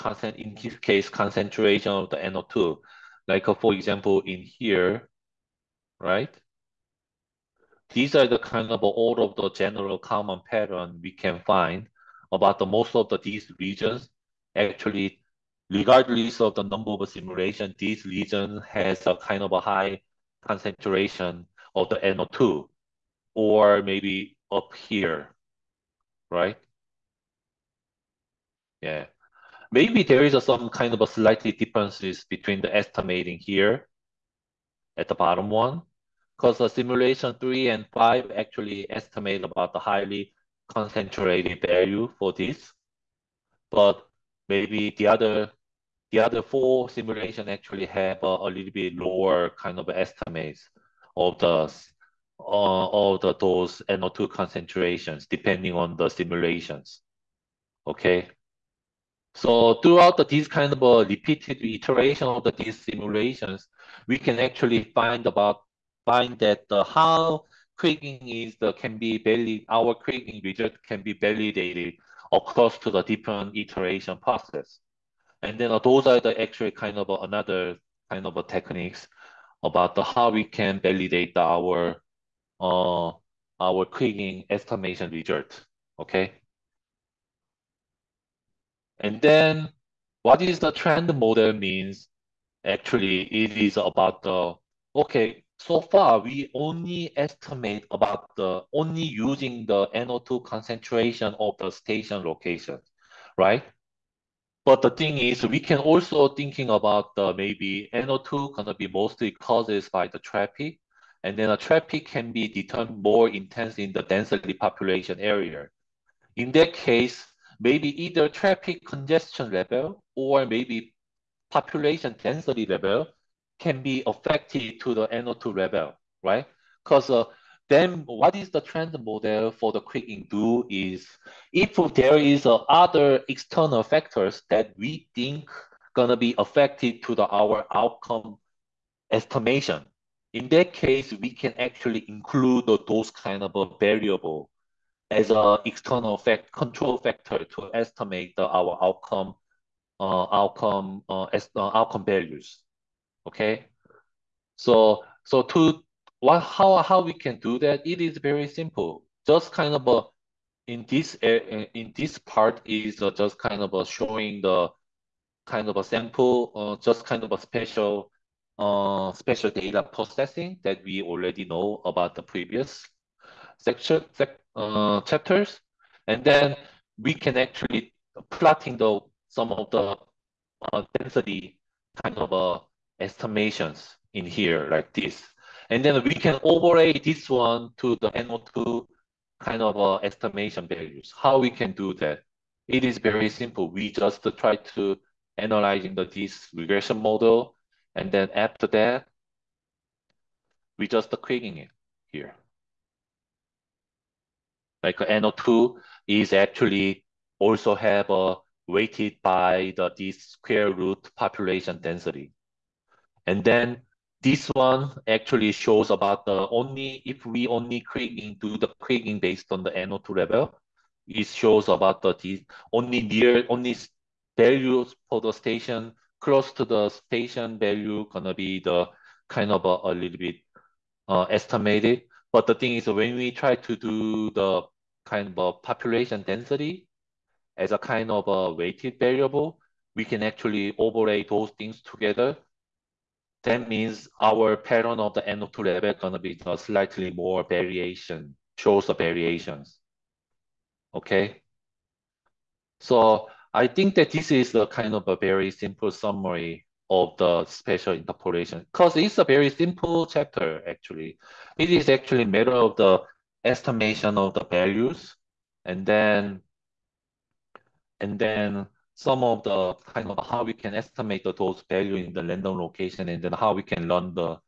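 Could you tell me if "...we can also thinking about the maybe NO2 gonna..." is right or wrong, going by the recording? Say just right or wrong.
right.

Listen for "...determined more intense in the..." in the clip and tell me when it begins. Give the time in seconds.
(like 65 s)
112 s.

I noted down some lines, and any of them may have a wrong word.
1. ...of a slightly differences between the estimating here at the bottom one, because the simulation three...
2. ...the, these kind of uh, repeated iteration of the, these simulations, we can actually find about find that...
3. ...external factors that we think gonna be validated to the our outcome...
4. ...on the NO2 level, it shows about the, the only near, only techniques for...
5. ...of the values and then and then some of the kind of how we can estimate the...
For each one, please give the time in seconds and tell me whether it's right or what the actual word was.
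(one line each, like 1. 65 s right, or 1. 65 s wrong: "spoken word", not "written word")
1. 30 s right
2. 60 s right
3. 133 s wrong: "affected", not "validated"
4. 219 s wrong: "values", not "techniques"
5. 264 s right.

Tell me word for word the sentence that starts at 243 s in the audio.
That means our pattern of the NO2 level gonna be slightly more variation, shows the variations.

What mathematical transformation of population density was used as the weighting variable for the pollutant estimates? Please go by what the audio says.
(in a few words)
Square root.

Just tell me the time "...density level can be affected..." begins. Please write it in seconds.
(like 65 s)
122 s.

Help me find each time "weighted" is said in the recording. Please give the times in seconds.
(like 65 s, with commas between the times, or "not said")
208 s, 238 s.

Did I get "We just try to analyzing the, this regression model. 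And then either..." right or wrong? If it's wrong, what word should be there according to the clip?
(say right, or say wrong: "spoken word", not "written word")
wrong: "after", not "either".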